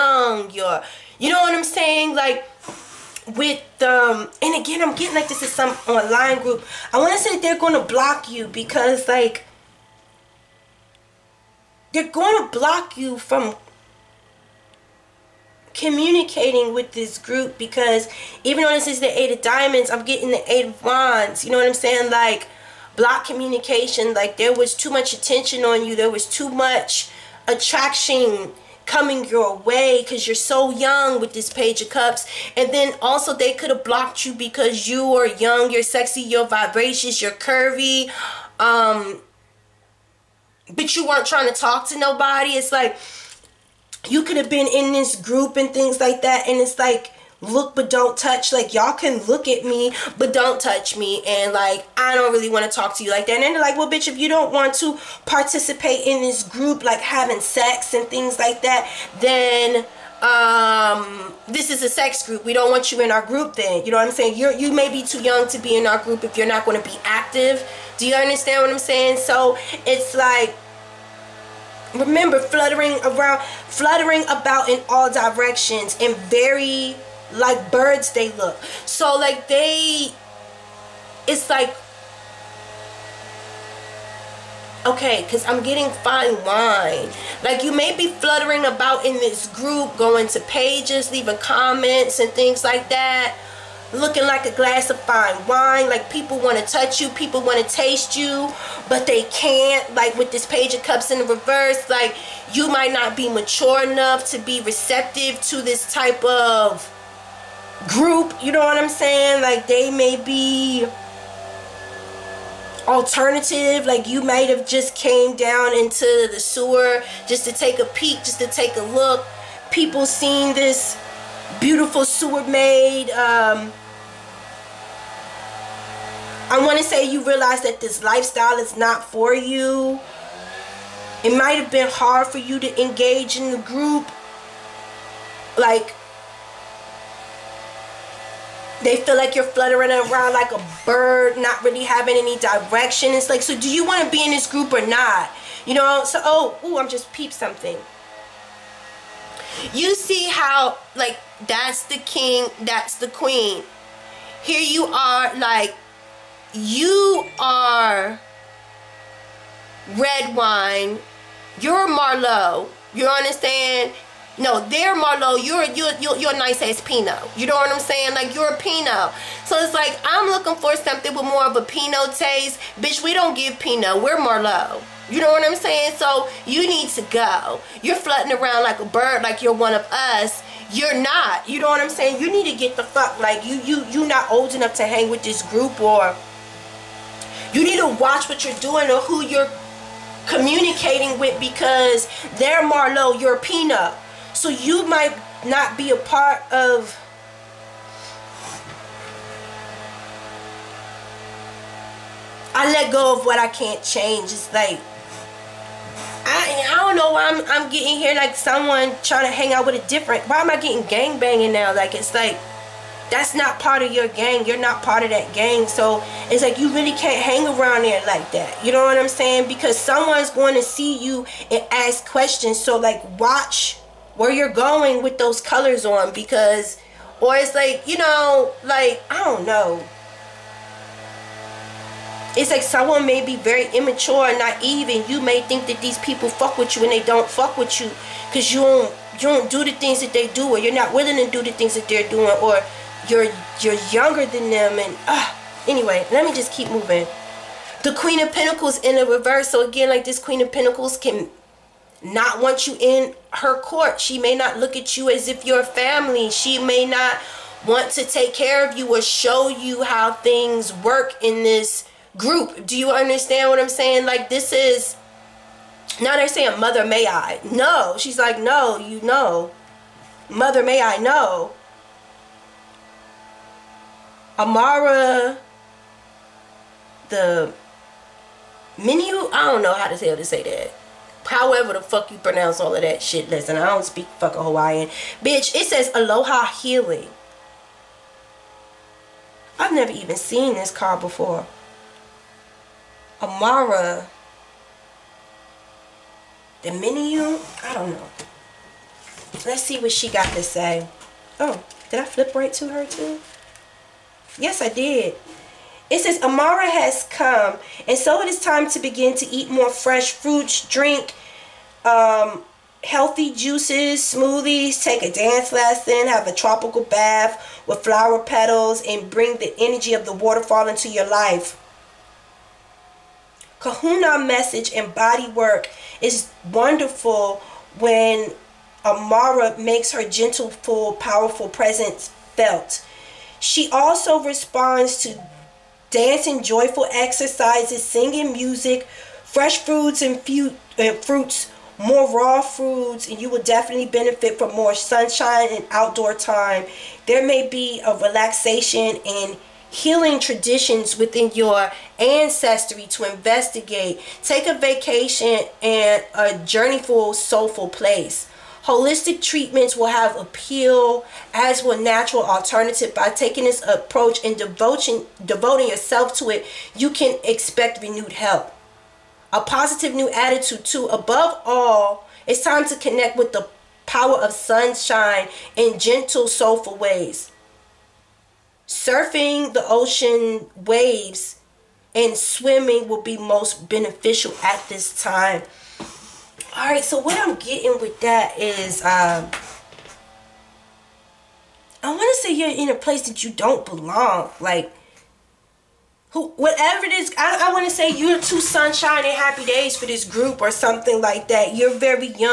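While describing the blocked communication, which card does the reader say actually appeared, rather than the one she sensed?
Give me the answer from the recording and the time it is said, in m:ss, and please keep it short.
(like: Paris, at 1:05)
Eight of Diamonds, at 0:19.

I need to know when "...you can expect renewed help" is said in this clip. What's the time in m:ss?
6:06.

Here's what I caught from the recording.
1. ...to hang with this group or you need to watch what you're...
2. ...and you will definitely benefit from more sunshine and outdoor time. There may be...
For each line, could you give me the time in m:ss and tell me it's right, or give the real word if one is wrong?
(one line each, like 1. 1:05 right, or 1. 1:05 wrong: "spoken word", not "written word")
1. 3:04 right
2. 5:43 right.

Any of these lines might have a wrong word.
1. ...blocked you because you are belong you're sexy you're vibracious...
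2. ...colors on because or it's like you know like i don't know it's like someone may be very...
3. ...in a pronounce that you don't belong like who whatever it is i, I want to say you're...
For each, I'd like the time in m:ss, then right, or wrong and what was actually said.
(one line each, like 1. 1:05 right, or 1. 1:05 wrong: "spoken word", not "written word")
1. 0:33 wrong: "young", not "belong"
2. 3:45 right
3. 6:32 wrong: "place", not "pronounce".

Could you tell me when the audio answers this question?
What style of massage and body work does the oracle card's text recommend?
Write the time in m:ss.
5:23.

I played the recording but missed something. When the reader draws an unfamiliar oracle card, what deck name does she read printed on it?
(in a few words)
Aloha Healing.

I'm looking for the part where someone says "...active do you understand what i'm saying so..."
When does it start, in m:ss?
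1:07.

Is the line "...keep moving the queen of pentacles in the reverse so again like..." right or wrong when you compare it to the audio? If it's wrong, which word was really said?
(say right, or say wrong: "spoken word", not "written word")
right.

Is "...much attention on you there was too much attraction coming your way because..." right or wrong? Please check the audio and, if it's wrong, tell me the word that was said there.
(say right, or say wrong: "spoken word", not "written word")
right.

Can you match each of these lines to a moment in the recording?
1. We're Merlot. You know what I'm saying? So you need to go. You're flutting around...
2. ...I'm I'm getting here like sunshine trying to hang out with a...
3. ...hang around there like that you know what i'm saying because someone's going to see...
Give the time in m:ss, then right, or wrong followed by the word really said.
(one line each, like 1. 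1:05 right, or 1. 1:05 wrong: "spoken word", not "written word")
1. 2:54 right
2. 3:27 wrong: "someone", not "sunshine"
3. 3:37 right.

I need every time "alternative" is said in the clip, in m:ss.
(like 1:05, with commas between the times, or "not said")
1:52, 6:02.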